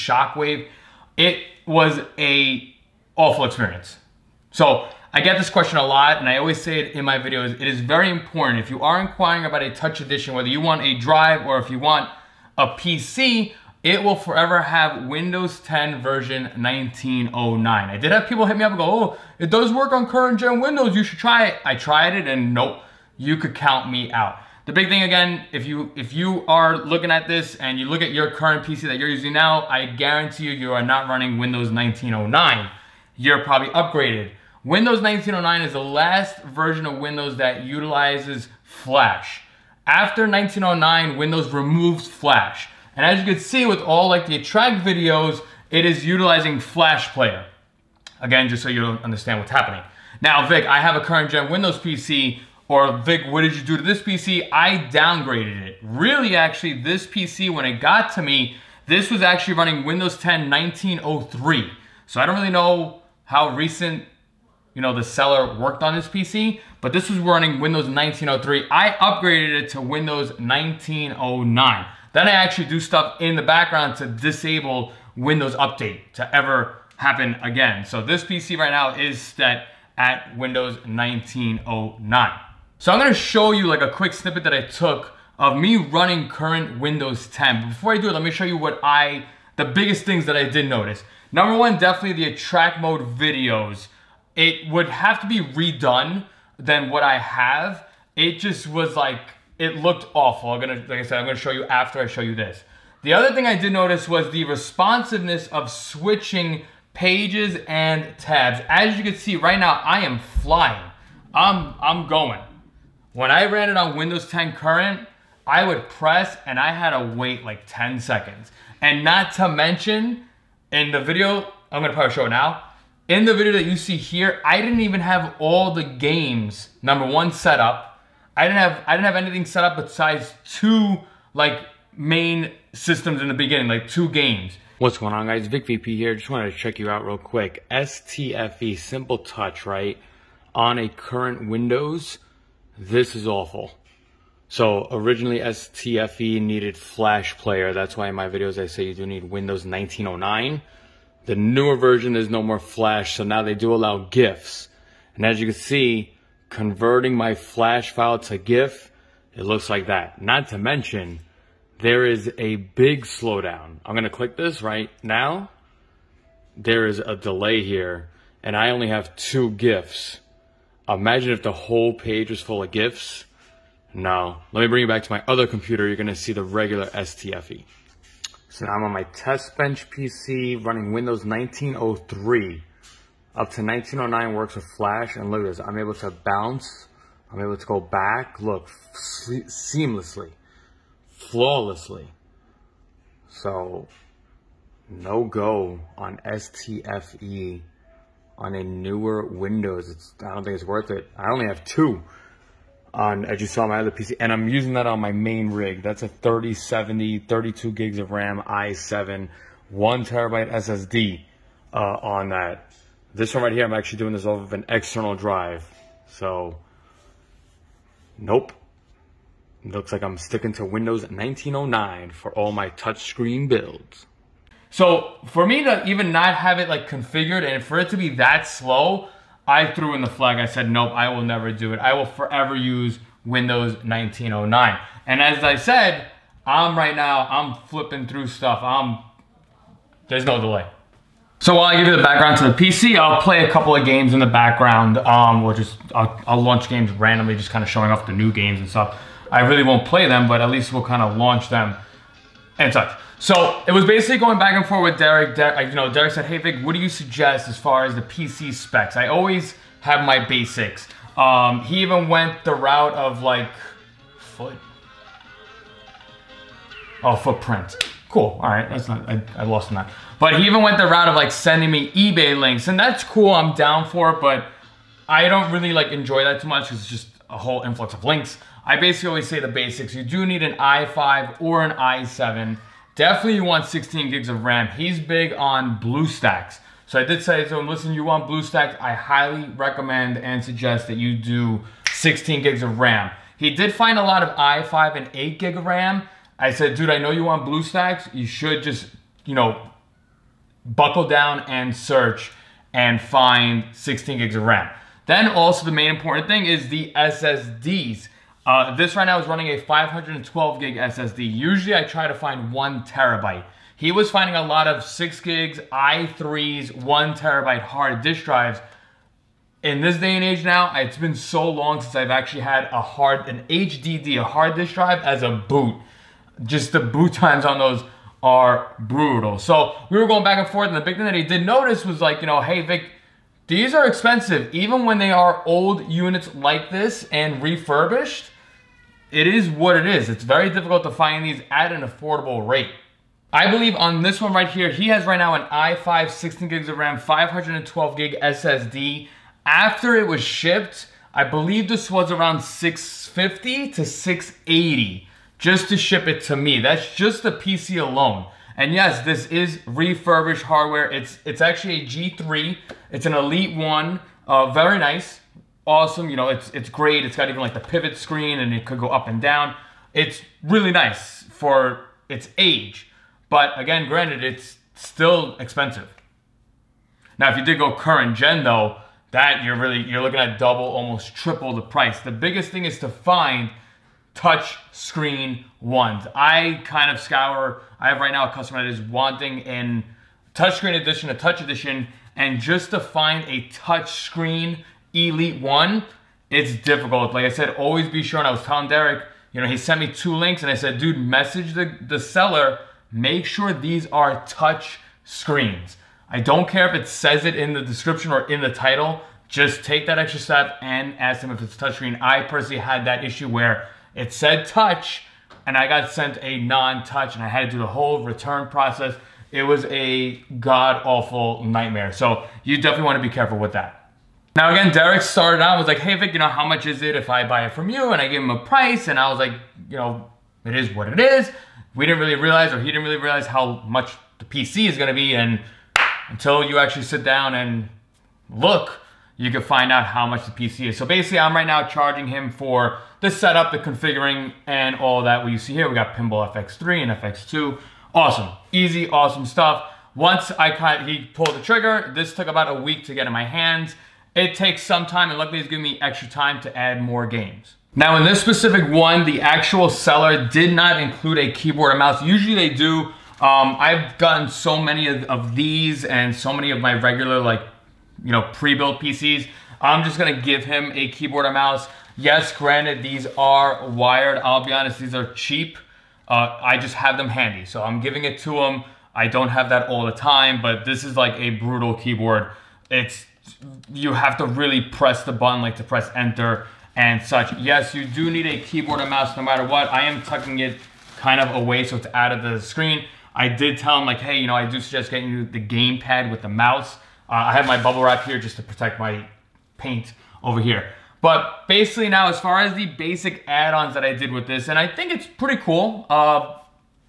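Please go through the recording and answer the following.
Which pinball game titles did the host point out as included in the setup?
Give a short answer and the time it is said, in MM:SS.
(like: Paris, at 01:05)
Pinball FX3 and FX2, at 07:25.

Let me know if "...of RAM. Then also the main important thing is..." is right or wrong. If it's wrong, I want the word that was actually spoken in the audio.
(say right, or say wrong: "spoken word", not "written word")
right.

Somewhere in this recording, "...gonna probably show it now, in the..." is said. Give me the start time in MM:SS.
02:01.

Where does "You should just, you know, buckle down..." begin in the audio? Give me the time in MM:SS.
04:58.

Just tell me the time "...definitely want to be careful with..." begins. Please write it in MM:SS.
07:02.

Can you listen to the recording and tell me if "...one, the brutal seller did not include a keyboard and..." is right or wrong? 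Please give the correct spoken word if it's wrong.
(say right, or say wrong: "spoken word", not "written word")
wrong: "actual", not "brutal".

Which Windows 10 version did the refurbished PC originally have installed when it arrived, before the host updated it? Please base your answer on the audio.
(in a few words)
1903.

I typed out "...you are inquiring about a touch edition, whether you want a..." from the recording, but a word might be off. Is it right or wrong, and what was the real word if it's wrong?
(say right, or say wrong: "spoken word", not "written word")
right.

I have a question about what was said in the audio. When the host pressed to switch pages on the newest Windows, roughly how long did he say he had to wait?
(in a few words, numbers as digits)
10 seconds.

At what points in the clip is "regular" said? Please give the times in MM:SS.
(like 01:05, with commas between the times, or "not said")
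02:56, 07:46.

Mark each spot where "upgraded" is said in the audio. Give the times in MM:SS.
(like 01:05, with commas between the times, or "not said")
00:33, 01:08.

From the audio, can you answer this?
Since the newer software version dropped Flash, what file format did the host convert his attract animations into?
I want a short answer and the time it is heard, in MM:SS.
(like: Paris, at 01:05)
GIF, at 02:38.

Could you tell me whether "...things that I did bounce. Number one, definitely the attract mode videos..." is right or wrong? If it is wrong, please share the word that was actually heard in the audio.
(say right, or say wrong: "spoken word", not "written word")
wrong: "notice", not "bounce".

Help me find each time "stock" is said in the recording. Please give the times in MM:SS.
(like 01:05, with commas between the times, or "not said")
not said.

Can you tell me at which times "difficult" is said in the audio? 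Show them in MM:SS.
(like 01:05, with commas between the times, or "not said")
05:40, 06:36.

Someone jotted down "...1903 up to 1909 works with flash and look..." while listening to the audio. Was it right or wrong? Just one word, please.
right.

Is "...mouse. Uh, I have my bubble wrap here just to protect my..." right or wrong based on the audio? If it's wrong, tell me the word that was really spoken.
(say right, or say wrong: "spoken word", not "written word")
right.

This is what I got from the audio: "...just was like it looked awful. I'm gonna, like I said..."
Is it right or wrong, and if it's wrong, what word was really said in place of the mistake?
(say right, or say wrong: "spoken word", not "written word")
right.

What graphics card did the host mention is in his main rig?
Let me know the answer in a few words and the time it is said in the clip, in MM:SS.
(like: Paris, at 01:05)
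3070, at 03:26.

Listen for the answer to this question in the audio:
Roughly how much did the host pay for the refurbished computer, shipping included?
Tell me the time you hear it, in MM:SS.
05:52.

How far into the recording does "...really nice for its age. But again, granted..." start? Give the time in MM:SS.
06:10.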